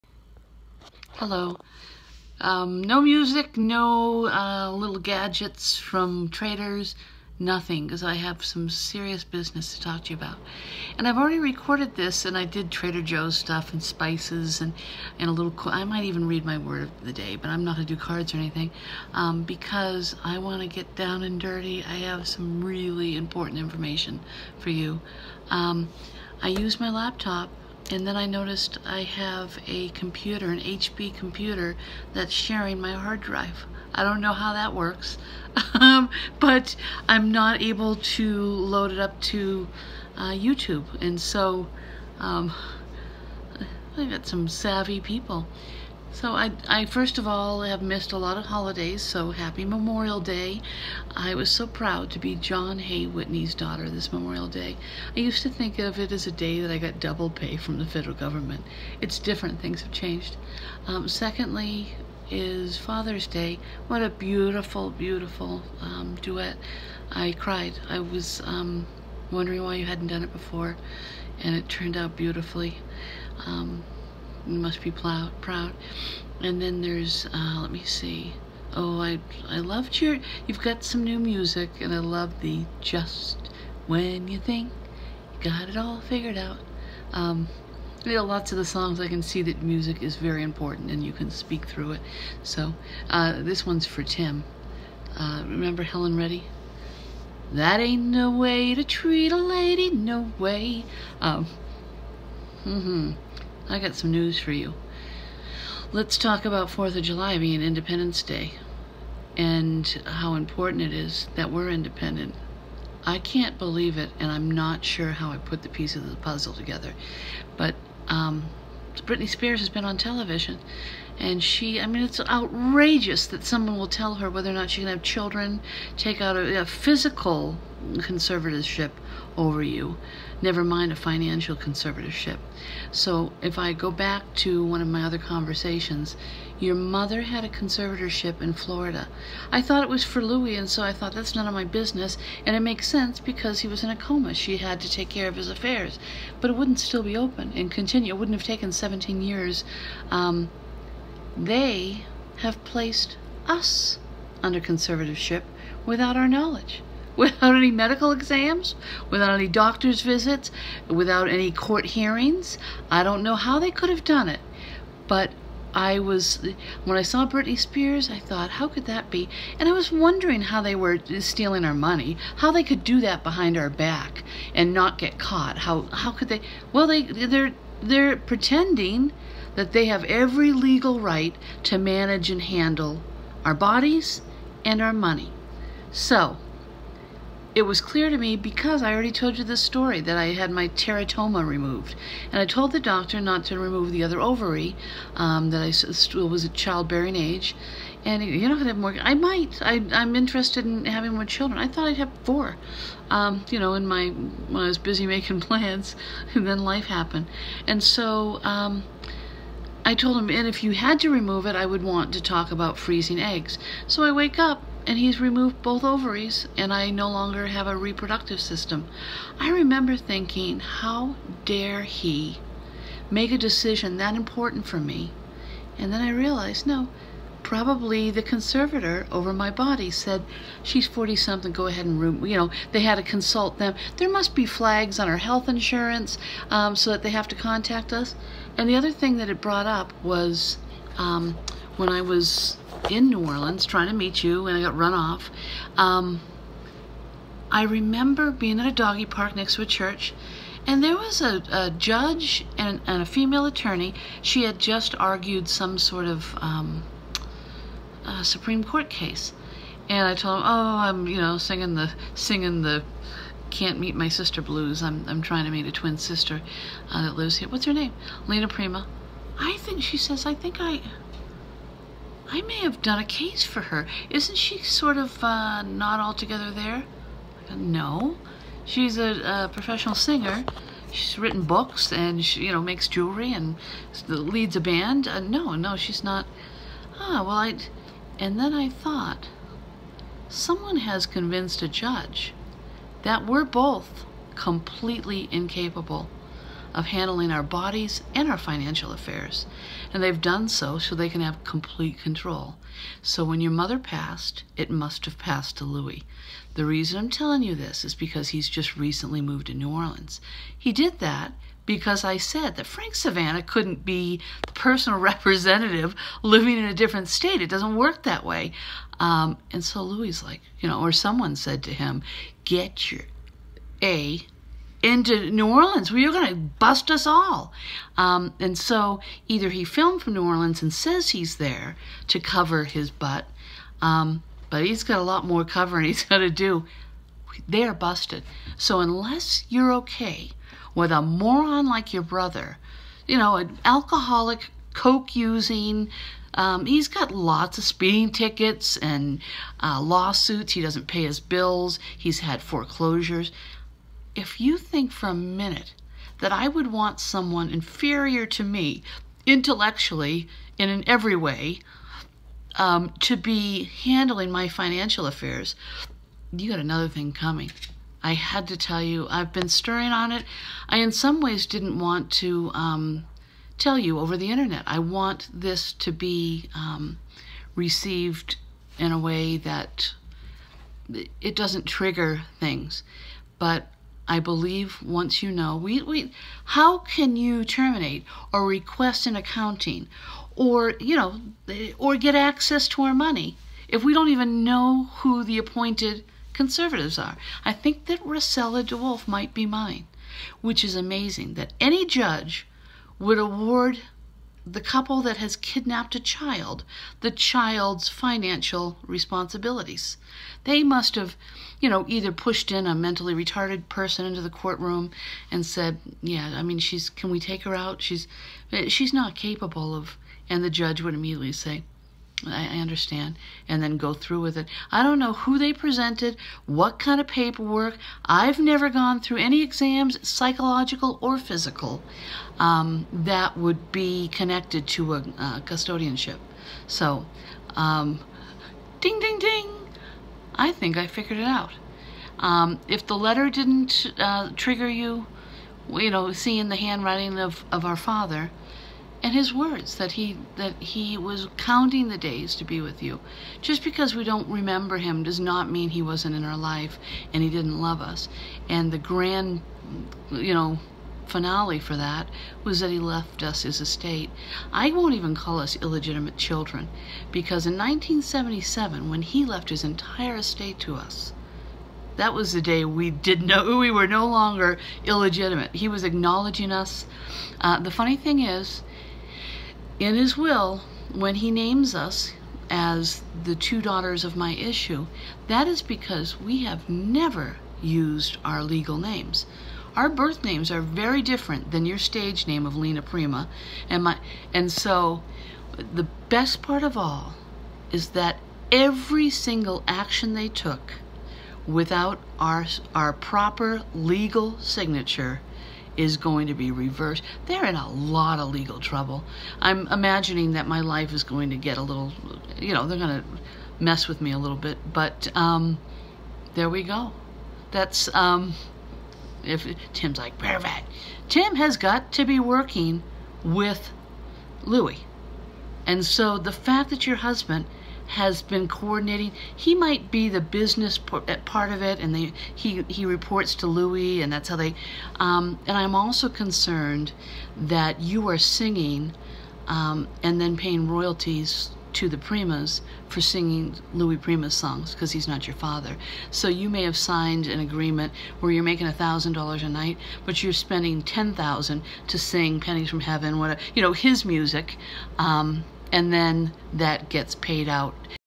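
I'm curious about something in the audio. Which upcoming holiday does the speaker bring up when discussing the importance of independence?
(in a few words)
4th of July.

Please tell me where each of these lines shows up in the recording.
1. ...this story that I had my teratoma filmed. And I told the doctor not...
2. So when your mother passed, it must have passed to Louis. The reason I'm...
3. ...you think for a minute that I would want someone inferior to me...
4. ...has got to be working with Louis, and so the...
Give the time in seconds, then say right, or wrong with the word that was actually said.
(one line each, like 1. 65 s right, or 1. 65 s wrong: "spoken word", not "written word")
1. 189 s wrong: "removed", not "filmed"
2. 303 s right
3. 354 s right
4. 521 s right.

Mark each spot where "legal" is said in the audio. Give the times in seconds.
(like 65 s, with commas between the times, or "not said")
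180 s, 488 s, 503 s, 508 s.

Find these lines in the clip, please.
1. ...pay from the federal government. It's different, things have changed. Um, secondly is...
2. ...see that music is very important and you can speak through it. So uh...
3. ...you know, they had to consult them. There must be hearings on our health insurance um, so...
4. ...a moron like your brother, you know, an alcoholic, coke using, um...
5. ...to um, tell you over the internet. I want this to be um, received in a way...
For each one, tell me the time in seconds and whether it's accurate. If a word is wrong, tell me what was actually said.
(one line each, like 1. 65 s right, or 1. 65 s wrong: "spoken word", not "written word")
1. 57 s right
2. 89 s right
3. 232 s wrong: "flags", not "hearings"
4. 340 s right
5. 372 s right.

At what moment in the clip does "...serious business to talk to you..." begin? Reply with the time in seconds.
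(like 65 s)
8 s.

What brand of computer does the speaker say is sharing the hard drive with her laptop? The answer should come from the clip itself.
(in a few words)
HP.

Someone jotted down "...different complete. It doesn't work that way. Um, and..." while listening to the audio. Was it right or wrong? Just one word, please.
wrong.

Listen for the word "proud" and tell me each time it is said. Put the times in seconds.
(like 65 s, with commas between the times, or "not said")
51 s, 75 s.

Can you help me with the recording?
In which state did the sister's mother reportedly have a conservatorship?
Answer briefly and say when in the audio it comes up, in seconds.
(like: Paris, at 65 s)
Florida, at 138 s.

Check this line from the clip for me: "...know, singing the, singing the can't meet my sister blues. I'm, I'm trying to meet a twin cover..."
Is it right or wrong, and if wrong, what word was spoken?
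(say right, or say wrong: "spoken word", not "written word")
wrong: "sister", not "cover".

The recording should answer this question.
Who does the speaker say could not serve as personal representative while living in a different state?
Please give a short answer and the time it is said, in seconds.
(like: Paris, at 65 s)
Frank Savannah, at 312 s.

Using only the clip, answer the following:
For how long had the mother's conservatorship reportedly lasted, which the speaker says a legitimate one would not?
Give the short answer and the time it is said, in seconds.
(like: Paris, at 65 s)
17 years, at 148 s.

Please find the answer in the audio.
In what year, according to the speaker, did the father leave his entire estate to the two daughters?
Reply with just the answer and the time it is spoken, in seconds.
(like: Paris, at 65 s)
1977, at 467 s.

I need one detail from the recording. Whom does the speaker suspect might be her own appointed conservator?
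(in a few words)
Rosella DeWolf.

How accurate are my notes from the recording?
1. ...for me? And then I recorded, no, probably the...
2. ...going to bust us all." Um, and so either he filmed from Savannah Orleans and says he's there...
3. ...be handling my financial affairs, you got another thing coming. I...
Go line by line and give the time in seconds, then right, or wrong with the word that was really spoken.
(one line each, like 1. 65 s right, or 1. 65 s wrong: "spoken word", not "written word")
1. 224 s wrong: "realized", not "recorded"
2. 326 s wrong: "New", not "Savannah"
3. 363 s right.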